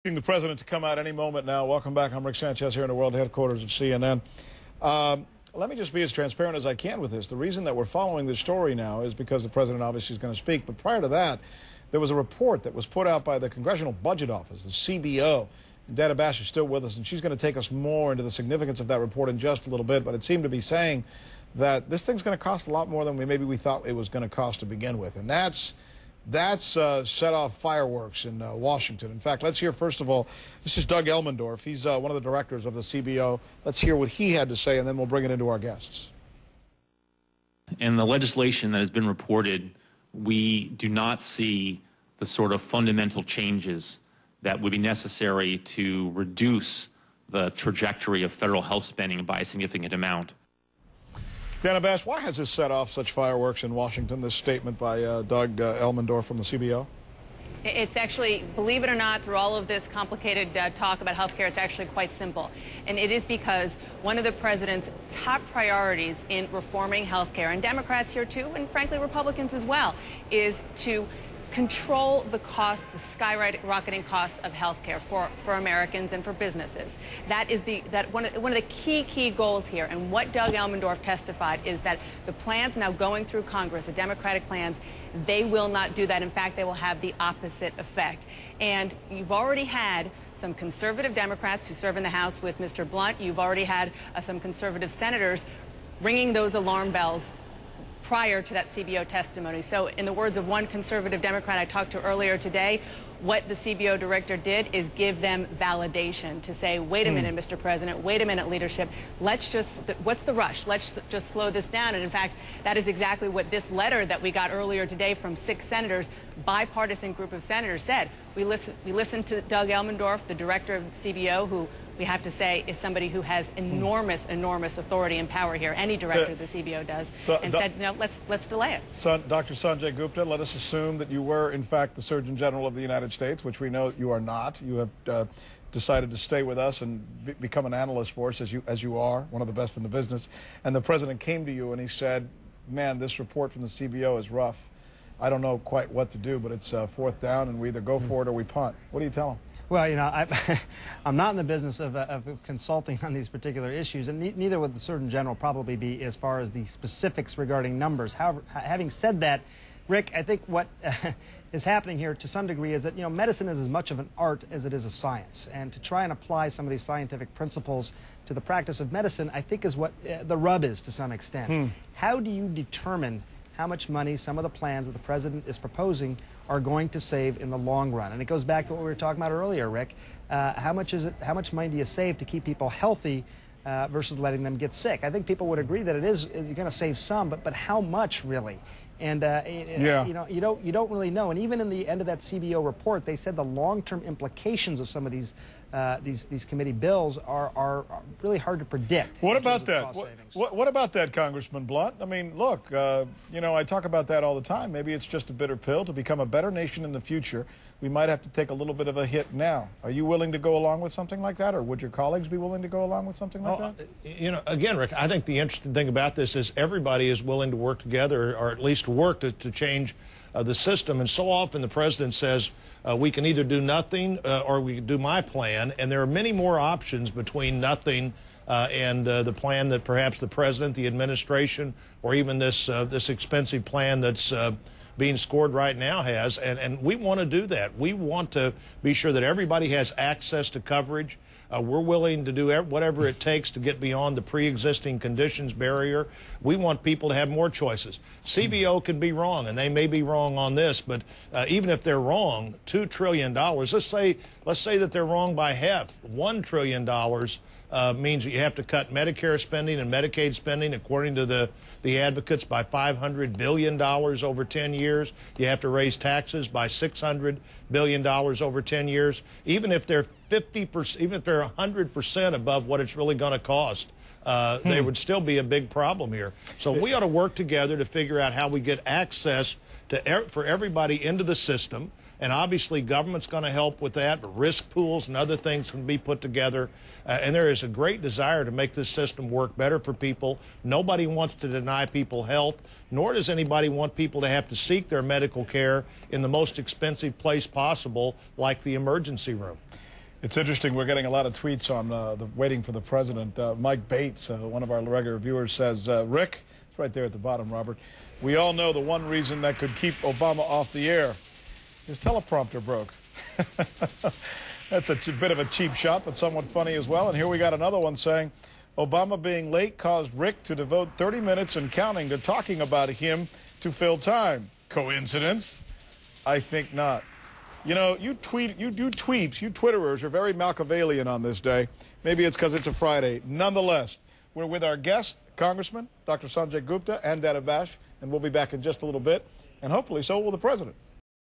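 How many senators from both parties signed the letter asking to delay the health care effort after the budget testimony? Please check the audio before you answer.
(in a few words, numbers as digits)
6.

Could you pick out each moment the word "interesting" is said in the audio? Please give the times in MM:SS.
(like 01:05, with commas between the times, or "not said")
03:35, 05:00.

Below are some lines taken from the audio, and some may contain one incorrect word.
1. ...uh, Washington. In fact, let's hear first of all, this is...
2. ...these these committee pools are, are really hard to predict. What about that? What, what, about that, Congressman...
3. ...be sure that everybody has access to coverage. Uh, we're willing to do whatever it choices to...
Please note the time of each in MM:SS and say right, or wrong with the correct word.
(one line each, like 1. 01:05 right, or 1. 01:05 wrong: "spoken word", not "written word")
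1. 00:28 right
2. 03:16 wrong: "bills", not "pools"
3. 03:58 wrong: "takes", not "choices".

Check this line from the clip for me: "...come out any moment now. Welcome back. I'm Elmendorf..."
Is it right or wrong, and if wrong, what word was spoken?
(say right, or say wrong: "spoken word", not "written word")
wrong: "Rick", not "Elmendorf".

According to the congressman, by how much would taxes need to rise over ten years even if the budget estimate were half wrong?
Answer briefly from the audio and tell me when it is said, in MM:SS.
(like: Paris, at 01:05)
$600 billion, at 04:26.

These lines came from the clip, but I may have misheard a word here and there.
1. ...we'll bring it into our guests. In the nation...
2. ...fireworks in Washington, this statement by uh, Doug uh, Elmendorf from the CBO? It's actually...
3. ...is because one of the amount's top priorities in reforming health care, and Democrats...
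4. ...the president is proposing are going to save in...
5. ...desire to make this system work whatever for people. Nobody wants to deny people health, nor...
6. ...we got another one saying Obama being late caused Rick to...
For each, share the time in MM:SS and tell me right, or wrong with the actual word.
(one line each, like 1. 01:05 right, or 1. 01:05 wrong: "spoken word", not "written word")
1. 00:34 wrong: "legislation", not "nation"
2. 00:53 right
3. 01:03 wrong: "president", not "amount"
4. 02:54 right
5. 04:48 wrong: "better", not "whatever"
6. 05:17 right.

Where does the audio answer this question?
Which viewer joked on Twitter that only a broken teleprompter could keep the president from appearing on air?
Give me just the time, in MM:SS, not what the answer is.
05:03.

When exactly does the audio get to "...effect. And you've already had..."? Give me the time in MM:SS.
01:27.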